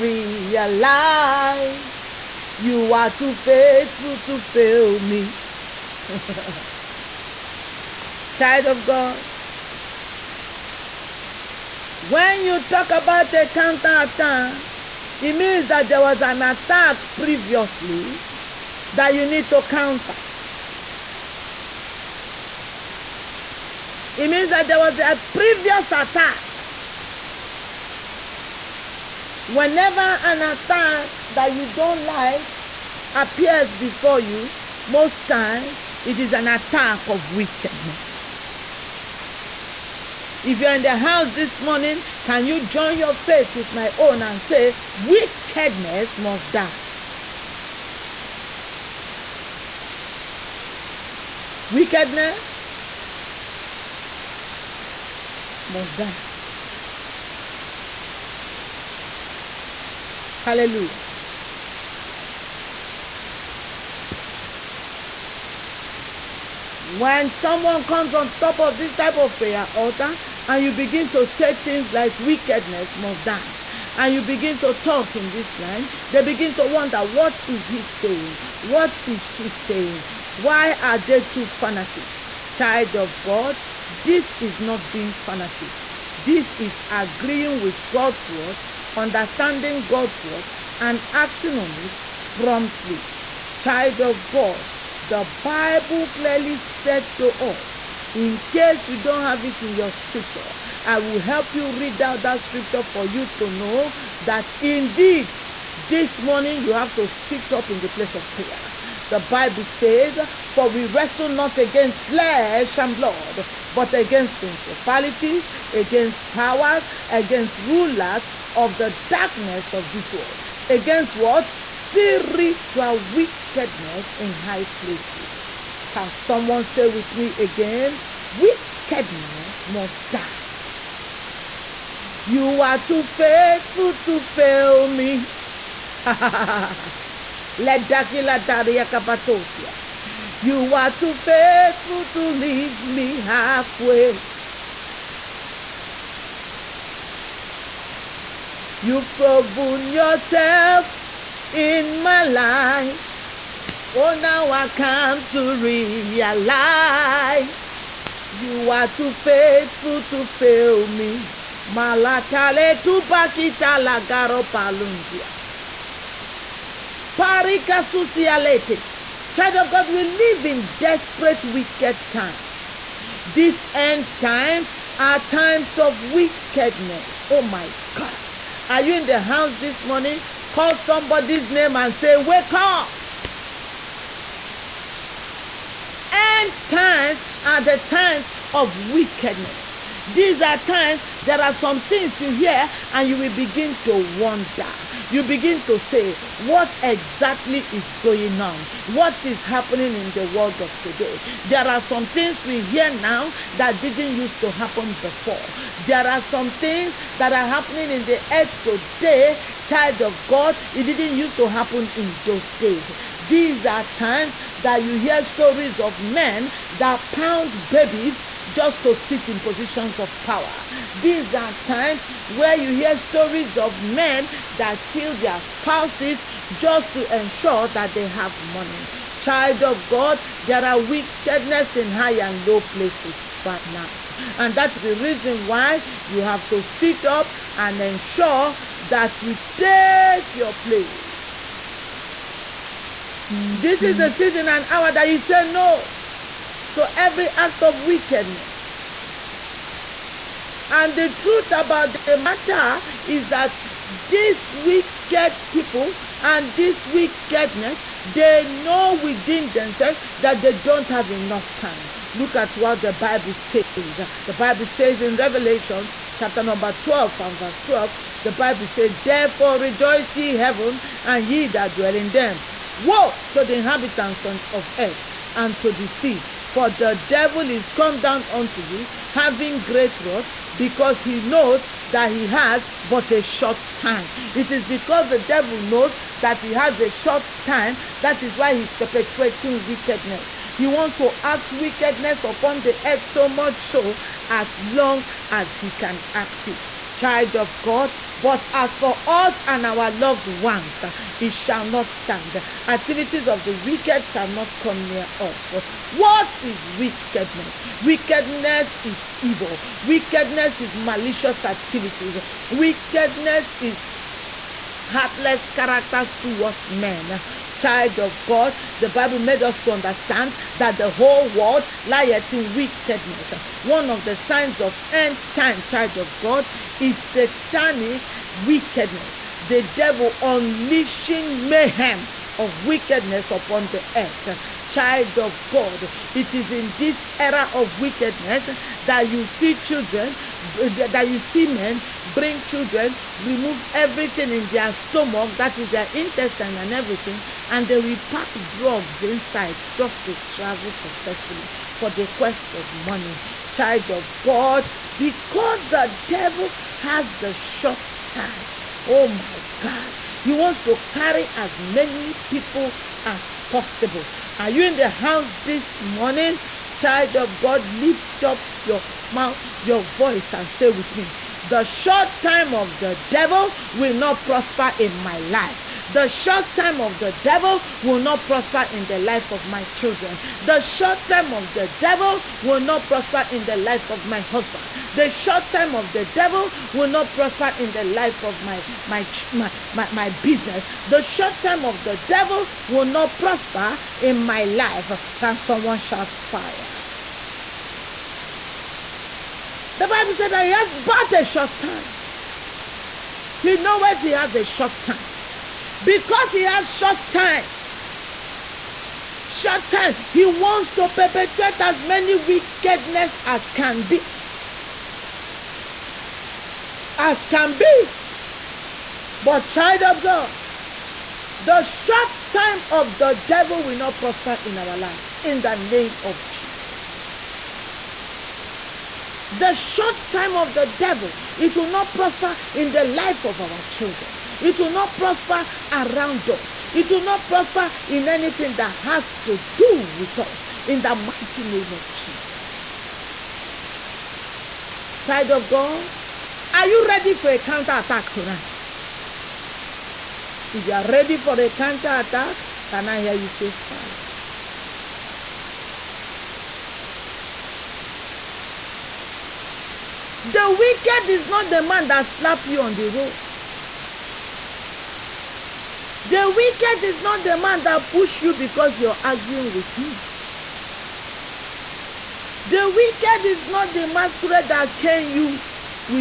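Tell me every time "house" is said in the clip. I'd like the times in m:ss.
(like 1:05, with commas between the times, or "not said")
0:40, 2:59, 6:04.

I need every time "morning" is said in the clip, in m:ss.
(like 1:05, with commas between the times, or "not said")
0:41, 1:46, 2:59, 6:05.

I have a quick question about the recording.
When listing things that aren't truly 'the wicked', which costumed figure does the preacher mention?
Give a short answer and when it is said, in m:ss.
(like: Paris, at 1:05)
masquerade, at 7:53.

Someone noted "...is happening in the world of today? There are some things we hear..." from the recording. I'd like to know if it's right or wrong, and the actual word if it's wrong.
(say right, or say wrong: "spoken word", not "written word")
right.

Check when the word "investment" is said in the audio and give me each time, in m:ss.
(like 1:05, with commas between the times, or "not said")
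not said.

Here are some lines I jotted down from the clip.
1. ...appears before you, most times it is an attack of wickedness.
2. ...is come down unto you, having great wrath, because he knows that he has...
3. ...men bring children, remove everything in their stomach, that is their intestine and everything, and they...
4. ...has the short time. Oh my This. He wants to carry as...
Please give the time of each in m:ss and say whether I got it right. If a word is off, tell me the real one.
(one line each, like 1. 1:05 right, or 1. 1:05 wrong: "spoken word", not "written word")
1. 0:33 right
2. 4:37 right
3. 5:41 right
4. 5:56 wrong: "God", not "This".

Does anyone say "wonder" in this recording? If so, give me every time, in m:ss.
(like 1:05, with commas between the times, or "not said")
1:16, 3:13.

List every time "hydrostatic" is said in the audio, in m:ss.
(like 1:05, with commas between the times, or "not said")
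not said.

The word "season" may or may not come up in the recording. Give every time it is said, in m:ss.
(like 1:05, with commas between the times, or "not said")
4:04.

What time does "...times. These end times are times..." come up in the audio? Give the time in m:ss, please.
2:52.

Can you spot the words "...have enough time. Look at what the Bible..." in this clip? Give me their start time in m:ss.
4:20.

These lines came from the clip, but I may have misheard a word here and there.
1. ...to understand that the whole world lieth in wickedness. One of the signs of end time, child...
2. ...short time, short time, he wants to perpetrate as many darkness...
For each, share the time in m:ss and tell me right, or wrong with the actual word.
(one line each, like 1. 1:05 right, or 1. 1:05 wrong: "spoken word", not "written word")
1. 5:19 right
2. 6:46 wrong: "wickedness", not "darkness".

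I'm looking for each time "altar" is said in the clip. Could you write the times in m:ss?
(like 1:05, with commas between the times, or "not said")
1:09.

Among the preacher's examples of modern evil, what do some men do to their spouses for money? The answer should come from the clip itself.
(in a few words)
kill their spouses.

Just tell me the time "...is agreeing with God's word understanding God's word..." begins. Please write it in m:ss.
1:26.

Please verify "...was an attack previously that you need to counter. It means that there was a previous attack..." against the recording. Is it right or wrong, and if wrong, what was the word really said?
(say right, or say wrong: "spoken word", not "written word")
right.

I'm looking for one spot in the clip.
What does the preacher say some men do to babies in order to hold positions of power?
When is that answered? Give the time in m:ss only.
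3:37.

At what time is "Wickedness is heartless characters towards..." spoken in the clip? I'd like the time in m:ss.
5:12.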